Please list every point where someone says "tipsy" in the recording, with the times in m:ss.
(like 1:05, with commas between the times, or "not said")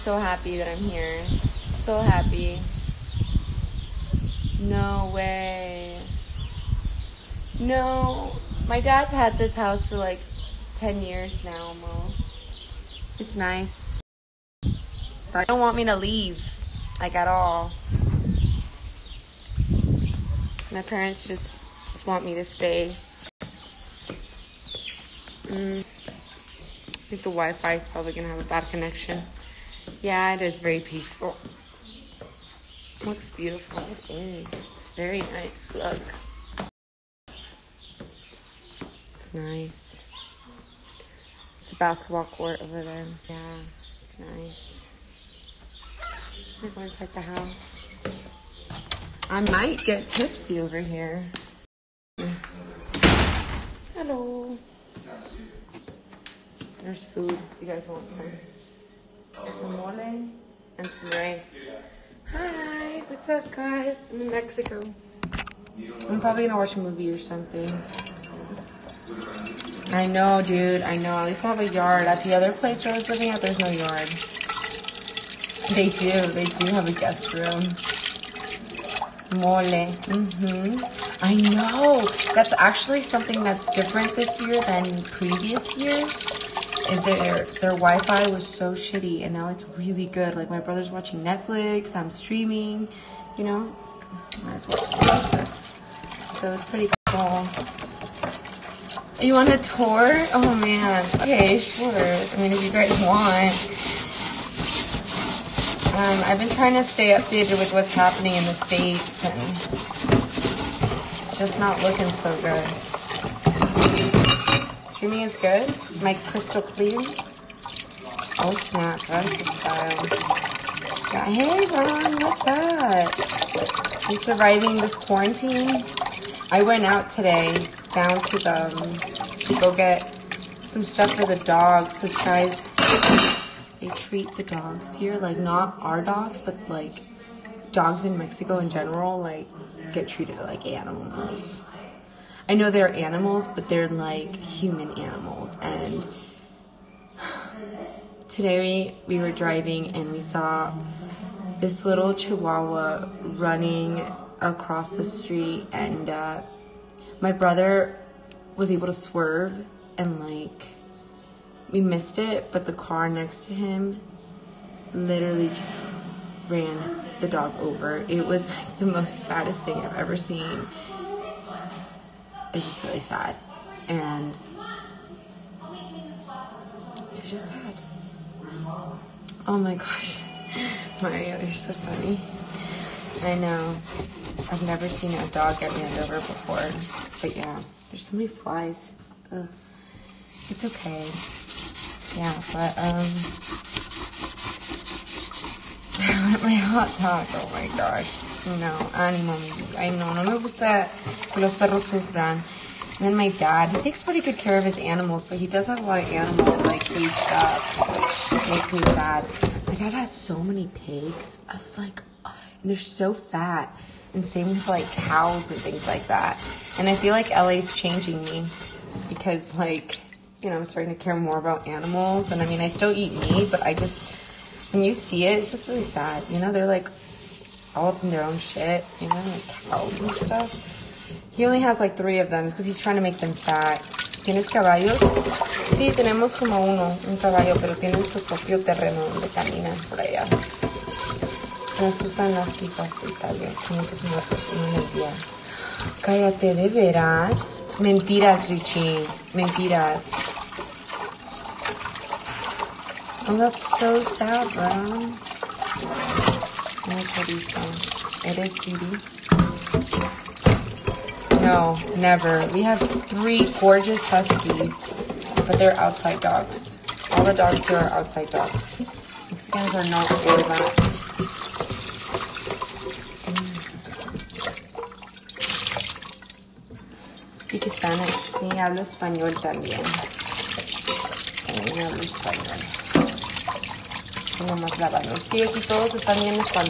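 0:50.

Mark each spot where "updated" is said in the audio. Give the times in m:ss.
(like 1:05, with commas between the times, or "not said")
1:47.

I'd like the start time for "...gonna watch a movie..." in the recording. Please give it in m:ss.
1:06.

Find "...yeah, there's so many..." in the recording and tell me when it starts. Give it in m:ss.
3:07.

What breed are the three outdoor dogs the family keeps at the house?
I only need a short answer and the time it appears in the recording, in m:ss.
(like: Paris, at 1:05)
Huskies, at 4:24.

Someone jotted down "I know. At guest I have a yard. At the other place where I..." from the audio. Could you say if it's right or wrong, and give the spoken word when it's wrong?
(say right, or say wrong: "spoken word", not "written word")
wrong: "least", not "guest".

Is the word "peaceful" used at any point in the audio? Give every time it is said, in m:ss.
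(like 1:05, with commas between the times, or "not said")
0:30.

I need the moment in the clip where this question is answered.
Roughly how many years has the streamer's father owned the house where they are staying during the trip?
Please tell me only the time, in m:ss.
0:10.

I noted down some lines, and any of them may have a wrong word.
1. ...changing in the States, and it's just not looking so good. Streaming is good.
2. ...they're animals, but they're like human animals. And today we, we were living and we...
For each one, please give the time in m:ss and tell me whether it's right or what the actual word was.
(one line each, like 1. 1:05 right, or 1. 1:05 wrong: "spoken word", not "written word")
1. 1:47 wrong: "happening", not "changing"
2. 2:22 wrong: "driving", not "living".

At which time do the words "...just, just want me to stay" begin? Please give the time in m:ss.
0:21.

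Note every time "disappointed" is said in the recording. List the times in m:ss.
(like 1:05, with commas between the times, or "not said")
not said.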